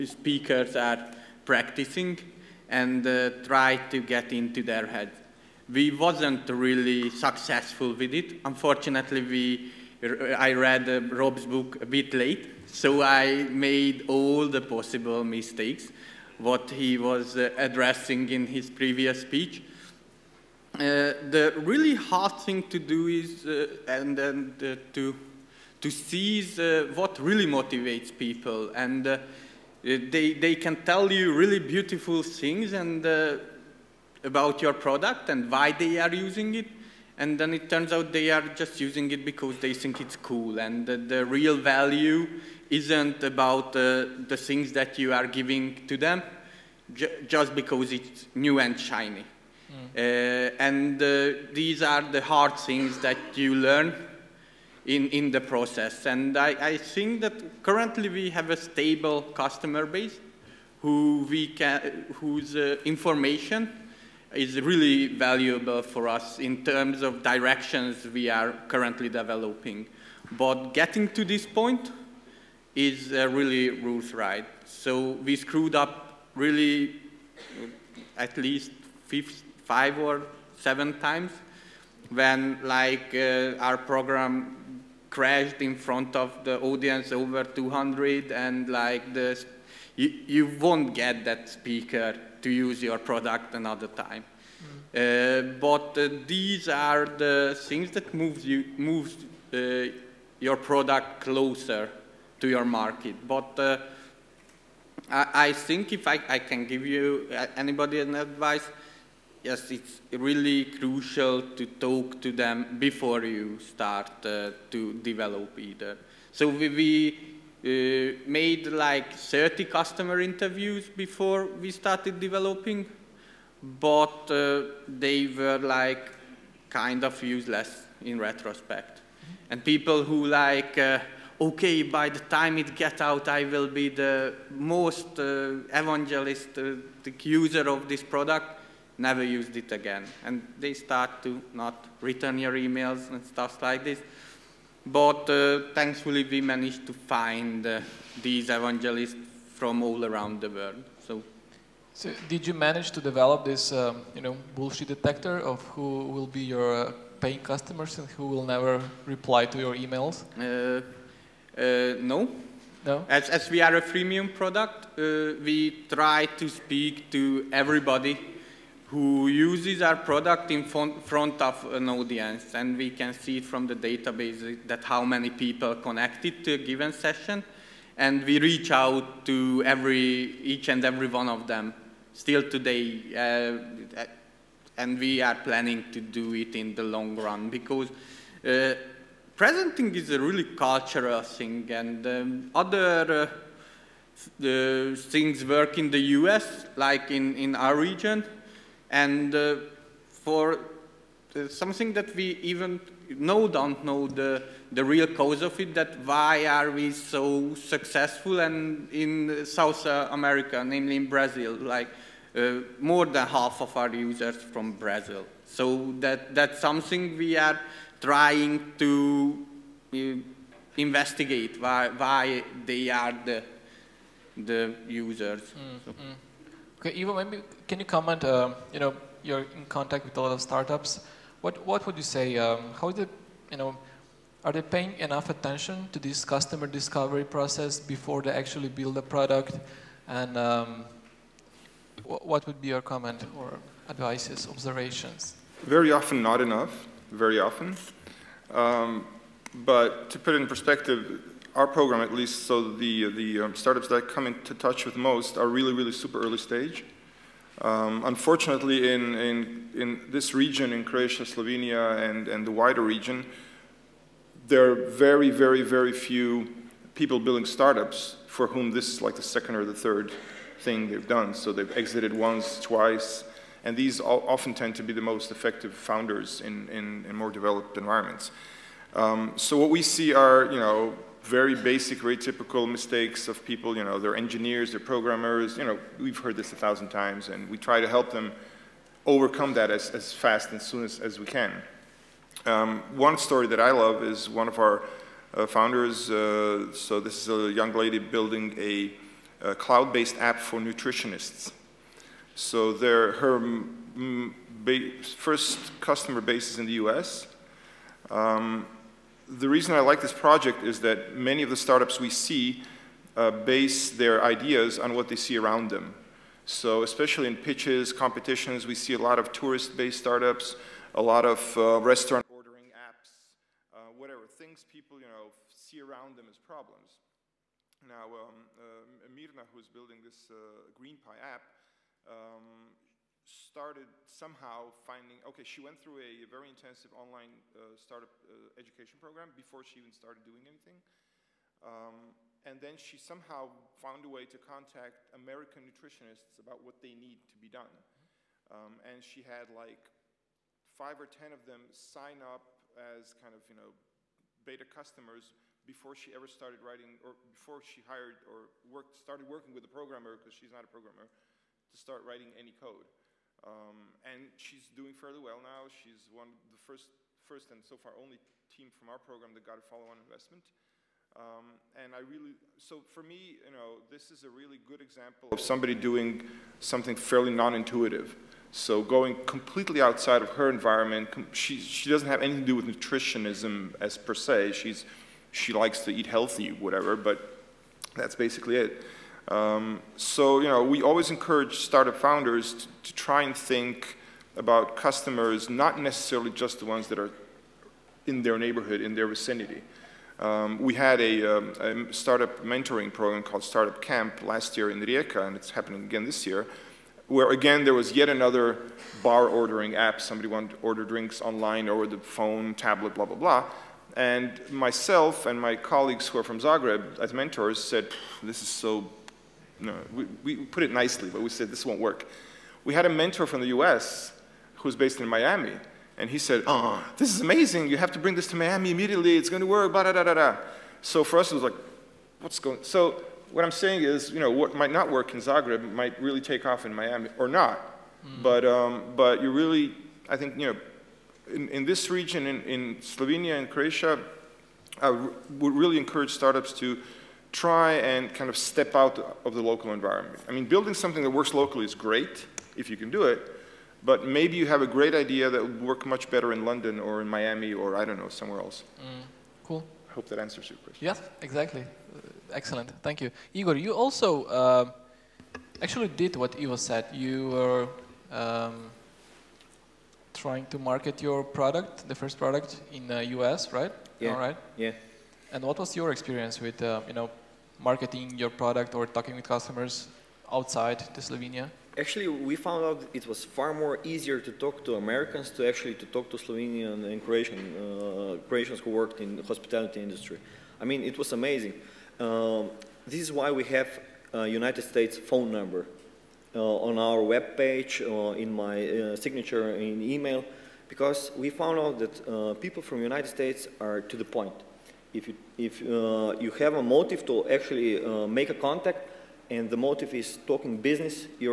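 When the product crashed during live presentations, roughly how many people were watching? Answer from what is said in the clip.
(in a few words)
over 200.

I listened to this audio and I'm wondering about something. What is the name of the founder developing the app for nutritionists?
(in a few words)
Mirna.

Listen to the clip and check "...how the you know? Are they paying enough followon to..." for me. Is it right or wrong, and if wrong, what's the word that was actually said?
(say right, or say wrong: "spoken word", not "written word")
wrong: "attention", not "followon".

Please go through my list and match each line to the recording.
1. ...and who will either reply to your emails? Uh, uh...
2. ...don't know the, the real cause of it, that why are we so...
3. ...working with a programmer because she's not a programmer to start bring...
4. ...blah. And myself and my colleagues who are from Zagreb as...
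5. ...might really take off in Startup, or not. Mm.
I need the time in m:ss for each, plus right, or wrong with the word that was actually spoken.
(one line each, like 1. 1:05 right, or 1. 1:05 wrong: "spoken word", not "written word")
1. 2:37 wrong: "never", not "either"
2. 3:23 right
3. 5:59 wrong: "writing", not "bring"
4. 6:53 right
5. 7:15 wrong: "Miami", not "Startup".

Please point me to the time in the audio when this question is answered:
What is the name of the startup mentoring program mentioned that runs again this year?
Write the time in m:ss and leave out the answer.
6:43.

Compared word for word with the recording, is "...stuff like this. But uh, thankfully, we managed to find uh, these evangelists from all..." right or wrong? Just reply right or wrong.
right.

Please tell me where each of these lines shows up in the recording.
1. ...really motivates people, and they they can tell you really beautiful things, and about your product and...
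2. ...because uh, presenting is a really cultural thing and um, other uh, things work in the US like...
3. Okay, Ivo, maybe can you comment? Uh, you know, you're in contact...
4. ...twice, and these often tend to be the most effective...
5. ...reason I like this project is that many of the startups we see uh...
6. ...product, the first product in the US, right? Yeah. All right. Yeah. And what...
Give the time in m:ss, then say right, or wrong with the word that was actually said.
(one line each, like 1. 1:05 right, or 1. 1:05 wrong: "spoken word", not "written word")
1. 0:27 right
2. 3:07 right
3. 3:46 right
4. 4:32 right
5. 5:09 right
6. 7:51 right.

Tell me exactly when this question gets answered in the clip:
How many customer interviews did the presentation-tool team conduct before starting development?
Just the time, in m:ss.
1:59.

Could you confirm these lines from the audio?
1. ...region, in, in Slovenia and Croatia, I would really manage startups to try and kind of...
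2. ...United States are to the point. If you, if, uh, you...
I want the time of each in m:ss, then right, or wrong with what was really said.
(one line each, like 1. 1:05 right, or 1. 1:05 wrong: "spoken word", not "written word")
1. 7:21 wrong: "encourage", not "manage"
2. 8:22 right.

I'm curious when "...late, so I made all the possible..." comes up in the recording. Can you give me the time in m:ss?
0:12.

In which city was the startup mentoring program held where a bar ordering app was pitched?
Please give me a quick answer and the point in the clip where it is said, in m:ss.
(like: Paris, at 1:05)
Rijeka, at 6:44.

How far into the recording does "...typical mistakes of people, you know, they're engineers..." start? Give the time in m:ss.
4:42.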